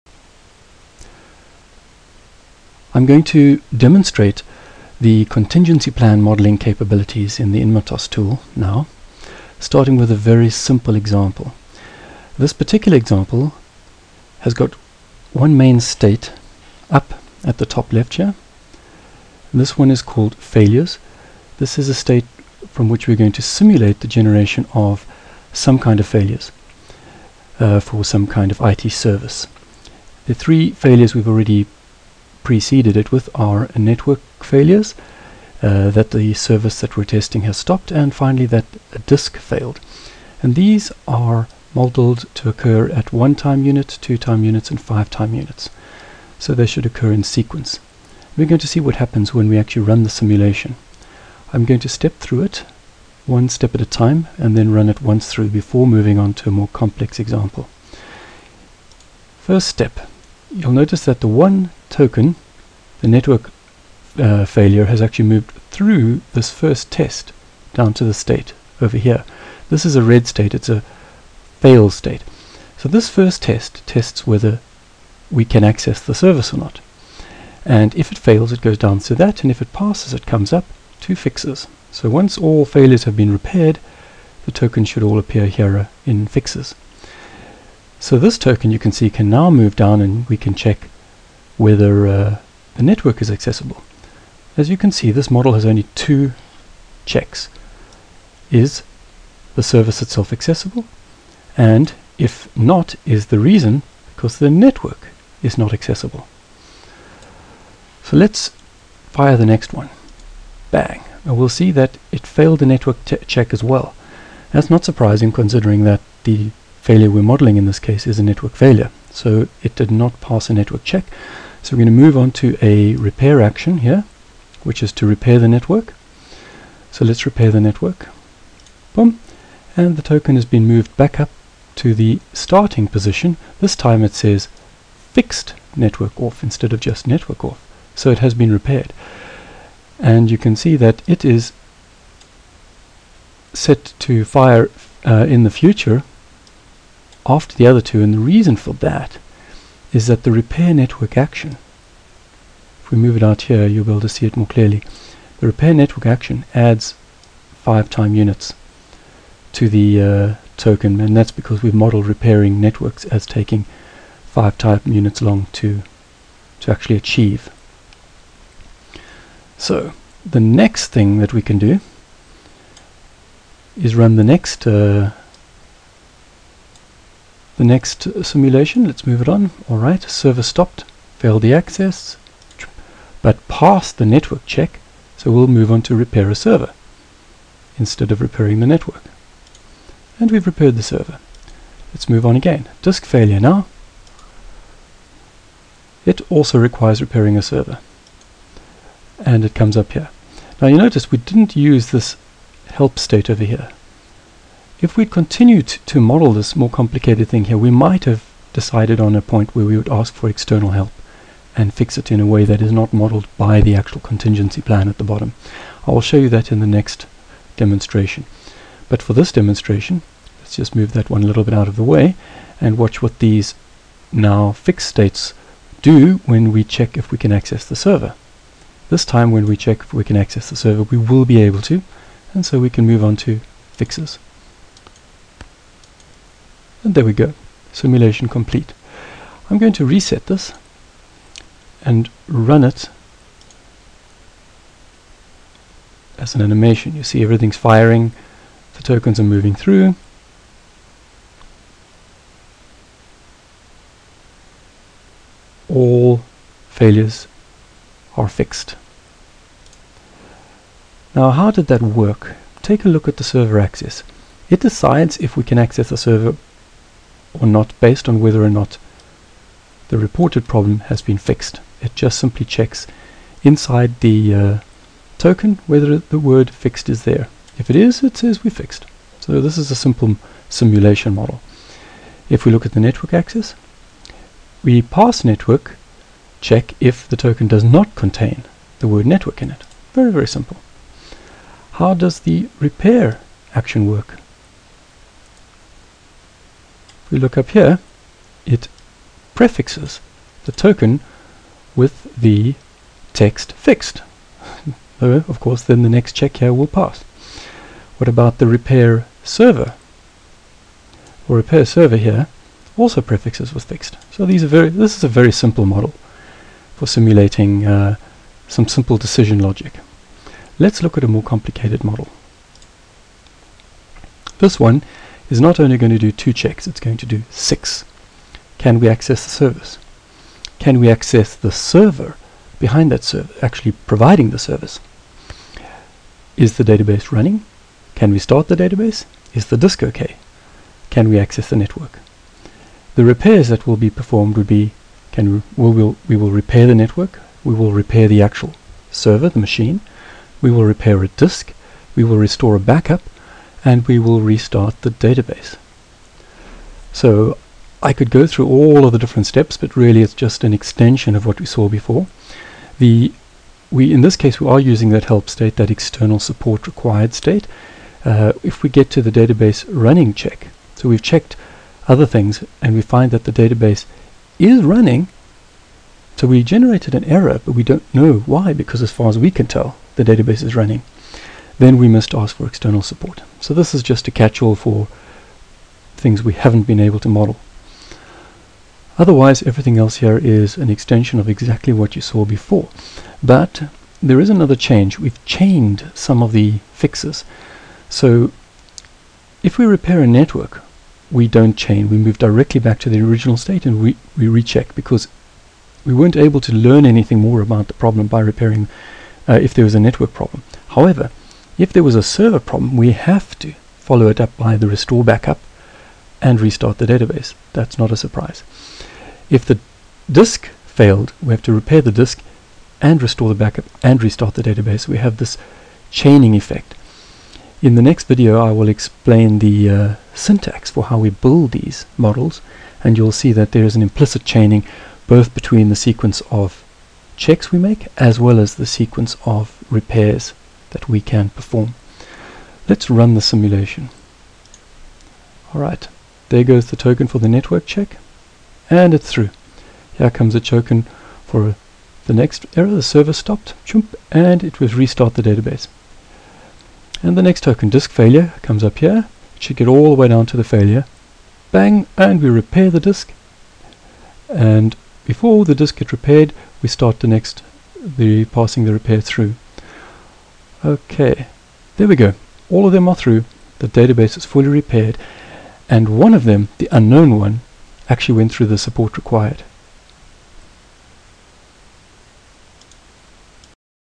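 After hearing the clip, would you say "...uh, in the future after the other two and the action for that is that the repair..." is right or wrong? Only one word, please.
wrong.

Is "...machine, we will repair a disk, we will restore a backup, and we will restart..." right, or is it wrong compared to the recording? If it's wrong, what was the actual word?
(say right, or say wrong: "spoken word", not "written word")
right.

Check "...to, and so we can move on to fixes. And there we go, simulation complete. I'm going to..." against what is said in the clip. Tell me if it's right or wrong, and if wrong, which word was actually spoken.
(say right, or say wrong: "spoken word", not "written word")
right.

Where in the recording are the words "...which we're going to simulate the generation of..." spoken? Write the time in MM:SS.
00:22.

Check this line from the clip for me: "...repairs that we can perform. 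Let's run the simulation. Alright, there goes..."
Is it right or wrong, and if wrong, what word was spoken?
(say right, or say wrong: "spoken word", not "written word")
right.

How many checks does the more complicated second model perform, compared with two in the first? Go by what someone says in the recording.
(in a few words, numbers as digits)
6.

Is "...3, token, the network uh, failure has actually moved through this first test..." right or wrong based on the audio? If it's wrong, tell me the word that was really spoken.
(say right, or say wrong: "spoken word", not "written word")
wrong: "1", not "3".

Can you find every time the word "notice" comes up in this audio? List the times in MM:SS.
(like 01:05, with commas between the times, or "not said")
01:00, 03:20.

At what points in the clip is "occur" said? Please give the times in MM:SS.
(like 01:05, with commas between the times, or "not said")
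00:42, 00:46.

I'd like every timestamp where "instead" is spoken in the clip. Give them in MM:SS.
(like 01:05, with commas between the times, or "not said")
02:16, 03:07.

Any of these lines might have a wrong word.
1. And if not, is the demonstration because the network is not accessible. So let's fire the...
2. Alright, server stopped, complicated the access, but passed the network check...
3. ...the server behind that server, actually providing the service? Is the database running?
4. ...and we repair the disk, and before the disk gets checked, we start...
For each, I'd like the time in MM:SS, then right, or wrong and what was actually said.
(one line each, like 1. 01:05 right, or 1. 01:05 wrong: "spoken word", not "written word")
1. 01:41 wrong: "reason", not "demonstration"
2. 02:59 wrong: "failed", not "complicated"
3. 05:31 right
4. 07:41 wrong: "repaired", not "checked".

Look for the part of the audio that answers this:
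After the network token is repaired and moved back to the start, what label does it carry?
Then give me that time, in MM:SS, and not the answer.
02:15.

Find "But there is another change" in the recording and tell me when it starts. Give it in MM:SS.
06:33.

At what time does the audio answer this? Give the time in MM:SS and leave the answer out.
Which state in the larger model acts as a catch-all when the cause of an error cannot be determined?
06:05.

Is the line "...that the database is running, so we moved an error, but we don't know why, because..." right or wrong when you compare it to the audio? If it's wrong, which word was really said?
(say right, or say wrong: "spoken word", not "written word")
wrong: "generated", not "moved".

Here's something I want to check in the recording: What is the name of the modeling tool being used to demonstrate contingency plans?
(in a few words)
INMOTOS.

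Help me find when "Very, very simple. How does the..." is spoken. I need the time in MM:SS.
04:49.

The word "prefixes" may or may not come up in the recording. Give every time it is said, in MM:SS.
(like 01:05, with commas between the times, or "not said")
04:59, 05:13.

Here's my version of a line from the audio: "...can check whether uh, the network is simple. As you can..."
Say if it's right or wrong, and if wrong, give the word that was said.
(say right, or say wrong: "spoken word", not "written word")
wrong: "accessible", not "simple".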